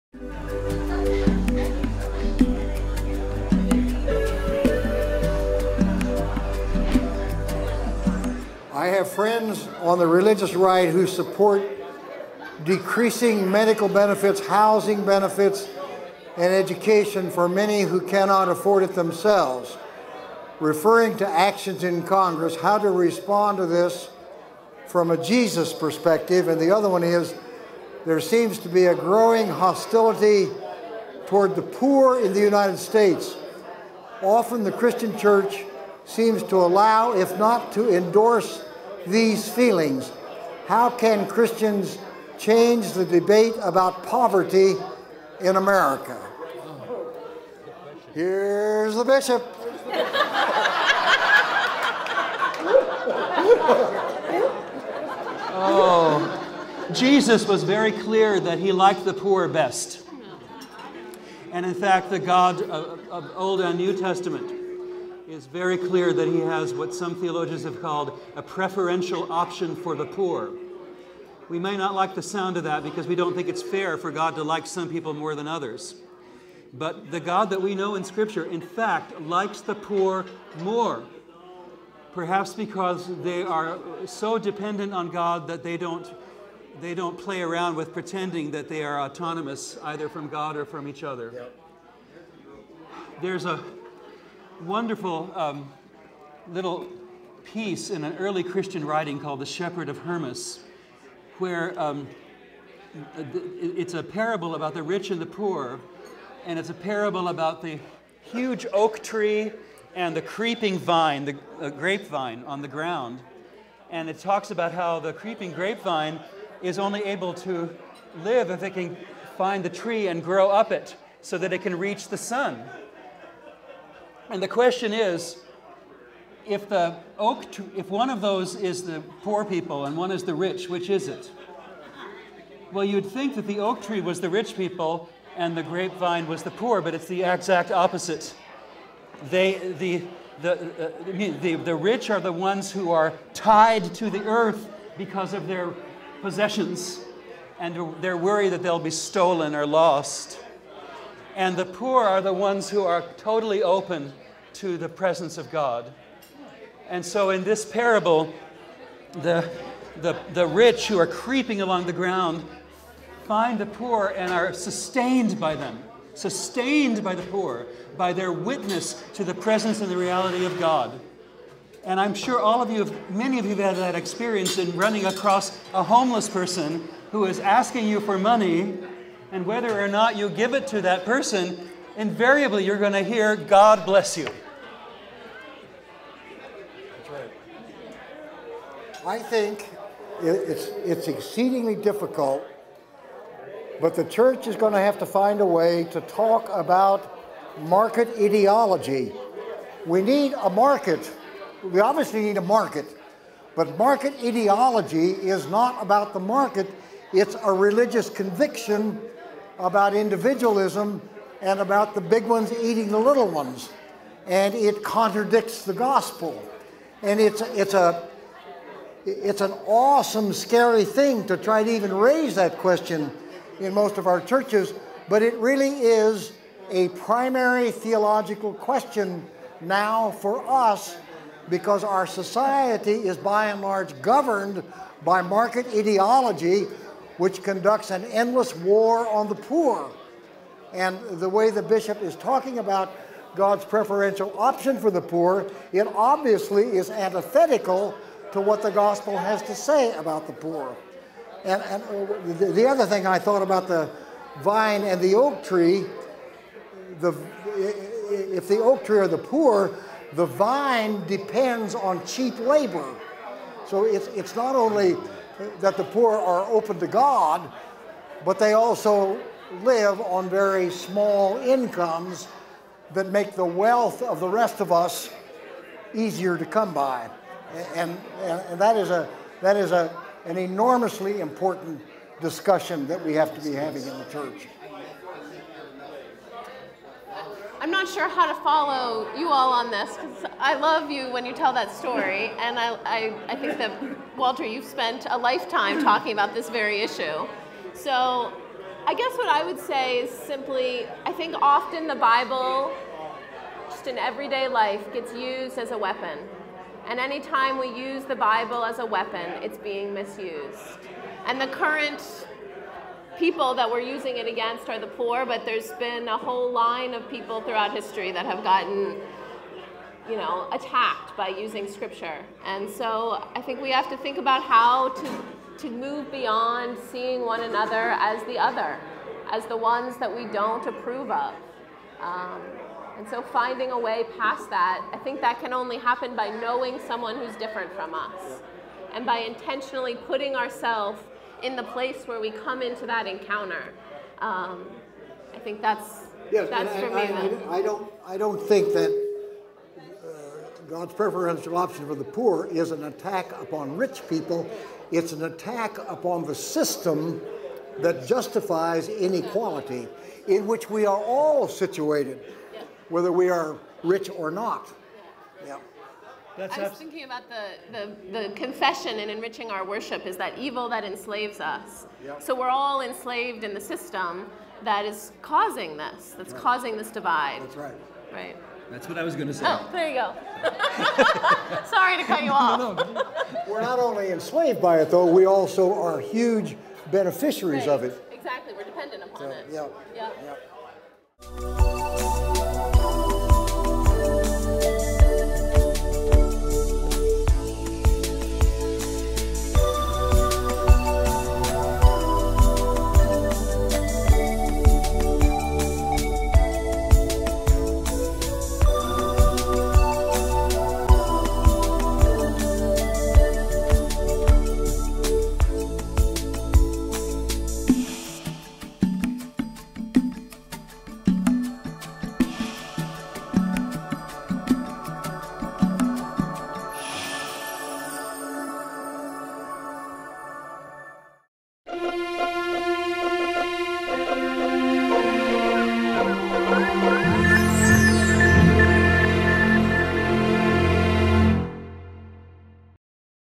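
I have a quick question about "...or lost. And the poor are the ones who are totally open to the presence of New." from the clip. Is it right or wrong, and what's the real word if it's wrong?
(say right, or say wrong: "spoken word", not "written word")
wrong: "God", not "New".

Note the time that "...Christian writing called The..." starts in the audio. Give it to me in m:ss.
1:38.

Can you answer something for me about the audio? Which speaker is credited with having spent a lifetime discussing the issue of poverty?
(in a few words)
Walter.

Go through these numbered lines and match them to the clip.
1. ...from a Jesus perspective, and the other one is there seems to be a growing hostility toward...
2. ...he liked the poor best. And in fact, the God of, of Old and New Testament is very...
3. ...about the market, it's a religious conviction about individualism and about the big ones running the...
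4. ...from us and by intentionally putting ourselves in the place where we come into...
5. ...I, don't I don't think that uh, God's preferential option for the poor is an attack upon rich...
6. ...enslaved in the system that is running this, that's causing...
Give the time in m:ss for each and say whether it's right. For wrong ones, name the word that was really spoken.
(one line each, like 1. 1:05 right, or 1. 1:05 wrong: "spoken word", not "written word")
1. 0:24 right
2. 0:58 right
3. 3:25 wrong: "eating", not "running"
4. 5:37 right
5. 5:47 right
6. 6:12 wrong: "causing", not "running".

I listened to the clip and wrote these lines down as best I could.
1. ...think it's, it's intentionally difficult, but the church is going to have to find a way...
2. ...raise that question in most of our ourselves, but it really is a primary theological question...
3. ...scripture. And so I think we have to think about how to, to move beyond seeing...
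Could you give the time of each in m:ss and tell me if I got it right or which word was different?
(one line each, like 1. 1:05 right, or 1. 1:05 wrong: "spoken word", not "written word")
1. 3:09 wrong: "exceedingly", not "intentionally"
2. 3:41 wrong: "churches", not "ourselves"
3. 5:21 right.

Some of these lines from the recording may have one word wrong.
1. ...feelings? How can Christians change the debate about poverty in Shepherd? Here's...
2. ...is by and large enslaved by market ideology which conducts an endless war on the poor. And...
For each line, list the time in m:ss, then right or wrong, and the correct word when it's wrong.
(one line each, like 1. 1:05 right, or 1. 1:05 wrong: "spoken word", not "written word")
1. 0:39 wrong: "America", not "Shepherd"
2. 3:52 wrong: "governed", not "enslaved".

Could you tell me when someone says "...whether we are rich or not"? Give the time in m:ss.
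6:02.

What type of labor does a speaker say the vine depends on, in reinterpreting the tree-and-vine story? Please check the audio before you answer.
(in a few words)
cheap labor.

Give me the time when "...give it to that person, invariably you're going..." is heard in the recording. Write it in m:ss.
3:00.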